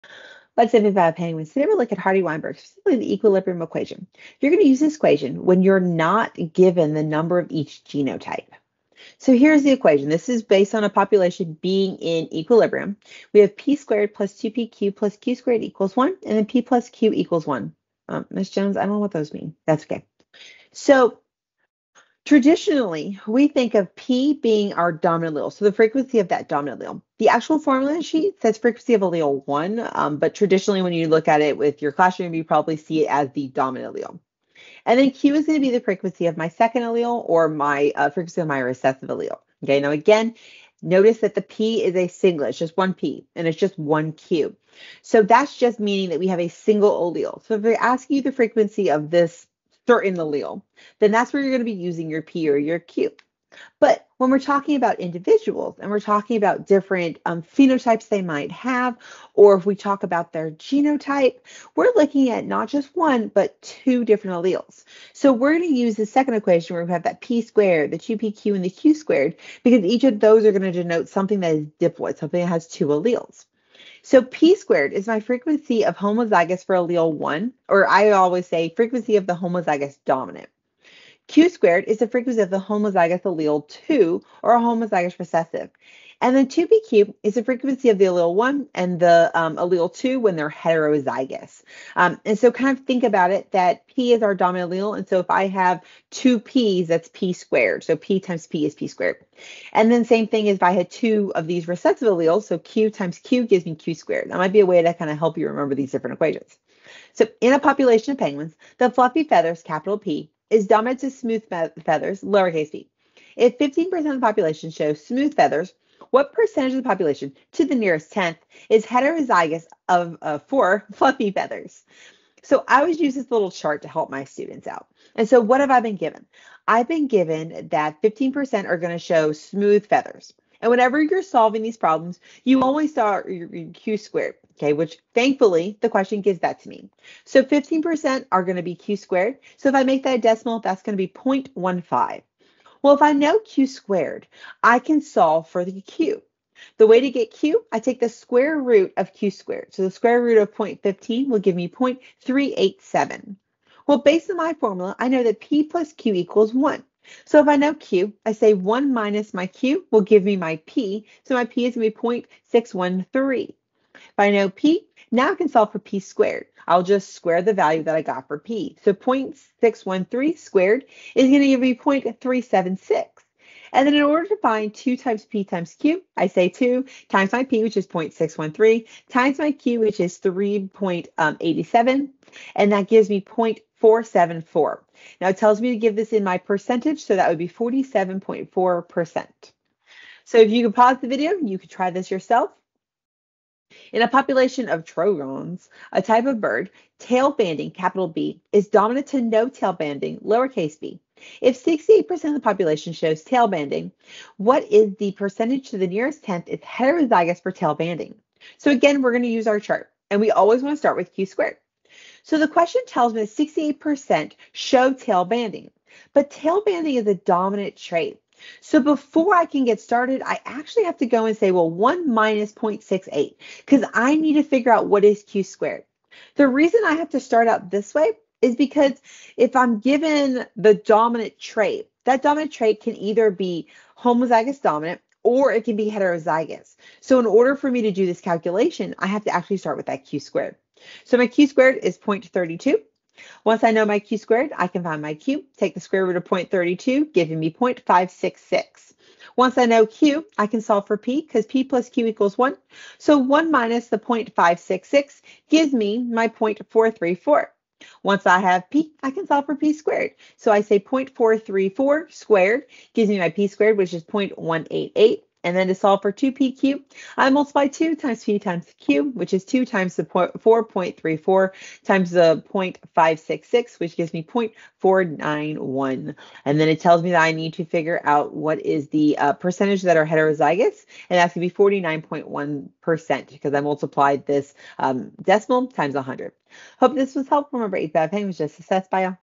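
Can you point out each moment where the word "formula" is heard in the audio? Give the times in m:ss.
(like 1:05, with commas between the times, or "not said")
0:27, 2:34.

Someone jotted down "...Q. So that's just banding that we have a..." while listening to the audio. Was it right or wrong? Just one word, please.
wrong.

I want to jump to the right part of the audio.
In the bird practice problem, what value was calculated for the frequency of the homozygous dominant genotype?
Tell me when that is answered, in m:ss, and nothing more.
4:24.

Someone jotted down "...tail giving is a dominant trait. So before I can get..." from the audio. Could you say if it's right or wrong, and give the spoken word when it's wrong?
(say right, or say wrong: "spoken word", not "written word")
wrong: "banding", not "giving".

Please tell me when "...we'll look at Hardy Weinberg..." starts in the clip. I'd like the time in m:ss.
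0:01.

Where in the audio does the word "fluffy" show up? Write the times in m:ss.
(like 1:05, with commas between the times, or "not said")
1:48, 2:00.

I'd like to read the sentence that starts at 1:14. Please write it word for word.
So P squared is my frequency of homozygous for allele 1, or I always say frequency of the homozygous dominant.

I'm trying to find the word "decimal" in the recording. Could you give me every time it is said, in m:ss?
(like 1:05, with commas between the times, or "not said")
2:20, 4:45.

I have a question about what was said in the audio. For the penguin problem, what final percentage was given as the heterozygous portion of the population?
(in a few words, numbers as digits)
47.4%.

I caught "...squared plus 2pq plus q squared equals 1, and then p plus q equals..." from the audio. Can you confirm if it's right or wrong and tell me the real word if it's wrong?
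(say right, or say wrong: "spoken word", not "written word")
right.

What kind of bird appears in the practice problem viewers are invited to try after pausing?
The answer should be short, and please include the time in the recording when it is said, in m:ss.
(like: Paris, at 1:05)
Trogons, at 3:14.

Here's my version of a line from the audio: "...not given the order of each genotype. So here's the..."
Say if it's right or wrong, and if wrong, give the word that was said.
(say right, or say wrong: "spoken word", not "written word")
wrong: "number", not "order".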